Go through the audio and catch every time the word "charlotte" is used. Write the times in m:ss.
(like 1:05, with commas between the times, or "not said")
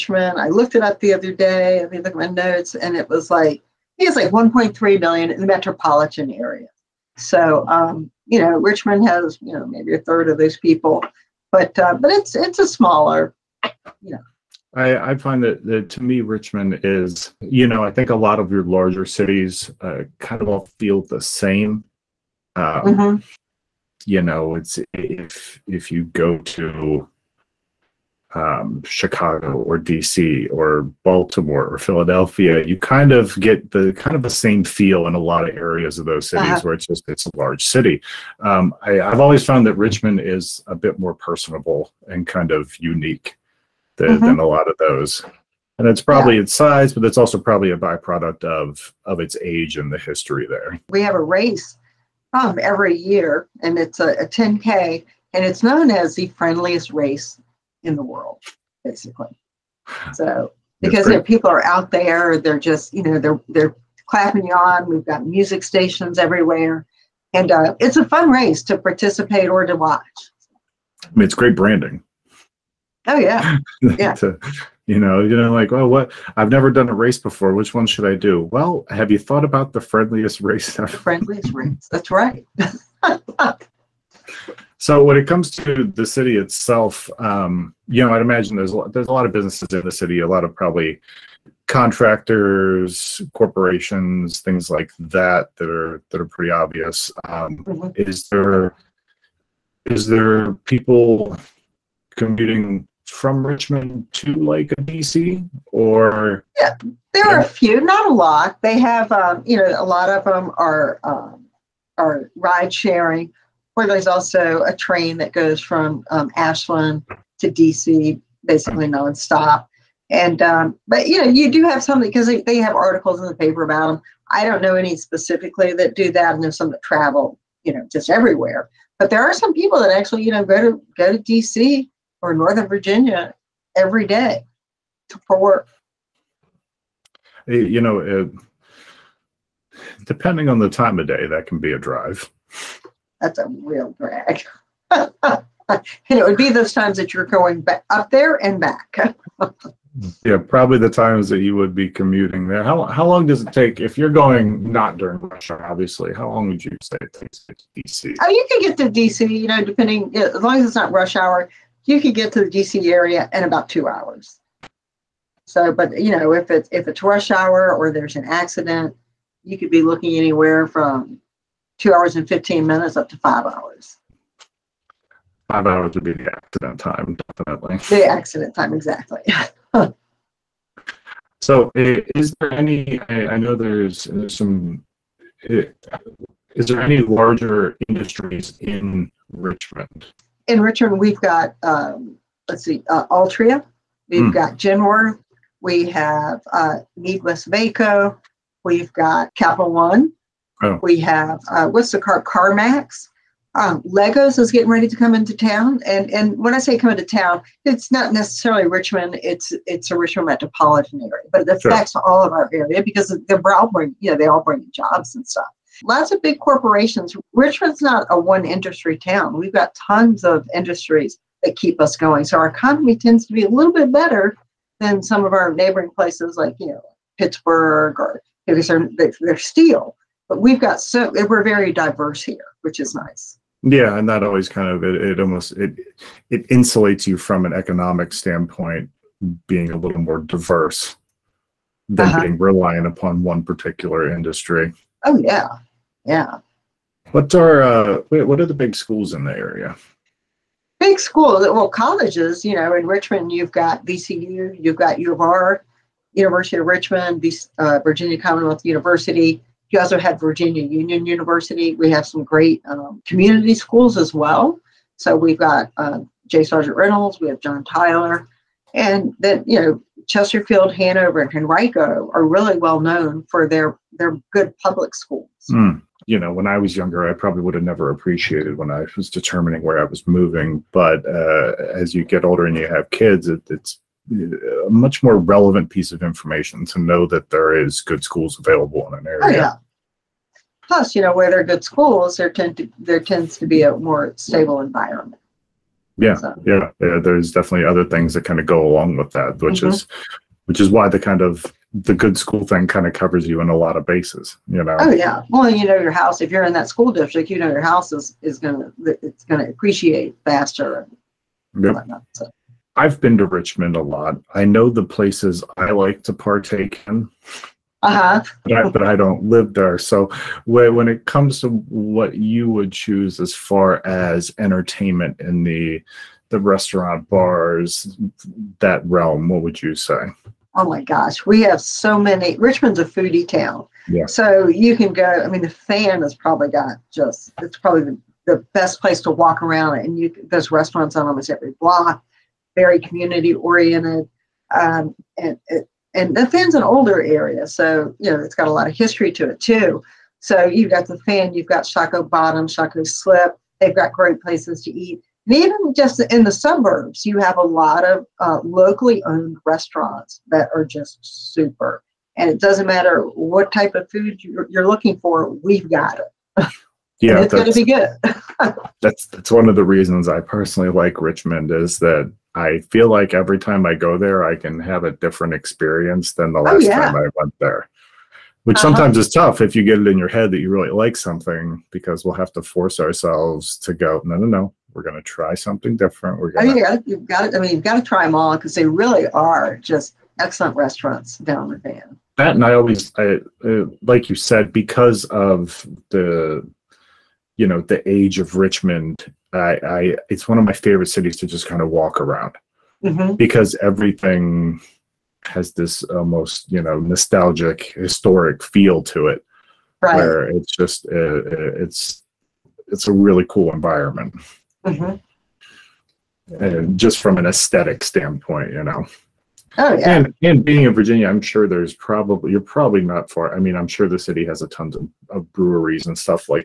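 not said.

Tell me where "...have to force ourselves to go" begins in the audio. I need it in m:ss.
6:22.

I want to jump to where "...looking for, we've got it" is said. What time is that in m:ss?
6:04.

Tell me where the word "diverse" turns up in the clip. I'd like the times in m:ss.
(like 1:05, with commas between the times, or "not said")
3:51, 4:00.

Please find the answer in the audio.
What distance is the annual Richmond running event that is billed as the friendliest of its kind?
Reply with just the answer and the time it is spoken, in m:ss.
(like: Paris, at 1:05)
10K, at 0:54.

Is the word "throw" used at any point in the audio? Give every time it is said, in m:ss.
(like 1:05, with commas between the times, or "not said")
not said.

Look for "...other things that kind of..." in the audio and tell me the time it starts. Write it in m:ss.
4:57.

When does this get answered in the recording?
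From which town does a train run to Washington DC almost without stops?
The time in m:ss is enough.
1:56.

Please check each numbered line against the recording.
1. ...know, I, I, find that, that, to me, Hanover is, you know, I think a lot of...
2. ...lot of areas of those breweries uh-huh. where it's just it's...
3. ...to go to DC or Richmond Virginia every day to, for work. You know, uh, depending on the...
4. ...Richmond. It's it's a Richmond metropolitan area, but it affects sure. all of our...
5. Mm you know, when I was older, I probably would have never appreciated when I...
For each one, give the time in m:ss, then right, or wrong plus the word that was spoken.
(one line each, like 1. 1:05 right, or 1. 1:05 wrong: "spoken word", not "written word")
1. 0:14 wrong: "Richmond", not "Hanover"
2. 0:35 wrong: "cities", not "breweries"
3. 2:10 wrong: "Northern", not "Richmond"
4. 3:28 right
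5. 4:35 wrong: "younger", not "older".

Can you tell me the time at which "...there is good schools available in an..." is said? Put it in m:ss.
4:47.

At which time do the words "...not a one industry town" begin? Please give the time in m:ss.
3:37.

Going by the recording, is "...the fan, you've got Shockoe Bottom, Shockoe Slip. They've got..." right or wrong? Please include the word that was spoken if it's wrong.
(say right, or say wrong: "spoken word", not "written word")
right.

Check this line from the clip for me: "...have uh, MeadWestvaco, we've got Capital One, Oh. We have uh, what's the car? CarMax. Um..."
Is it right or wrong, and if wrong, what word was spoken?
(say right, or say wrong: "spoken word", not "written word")
right.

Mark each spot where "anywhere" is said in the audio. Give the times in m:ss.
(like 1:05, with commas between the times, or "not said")
2:50.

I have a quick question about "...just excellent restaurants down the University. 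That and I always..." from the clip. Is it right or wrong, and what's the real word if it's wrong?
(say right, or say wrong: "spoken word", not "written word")
wrong: "Fan", not "University".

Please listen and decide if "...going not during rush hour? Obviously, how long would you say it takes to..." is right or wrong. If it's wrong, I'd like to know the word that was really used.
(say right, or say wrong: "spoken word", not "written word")
right.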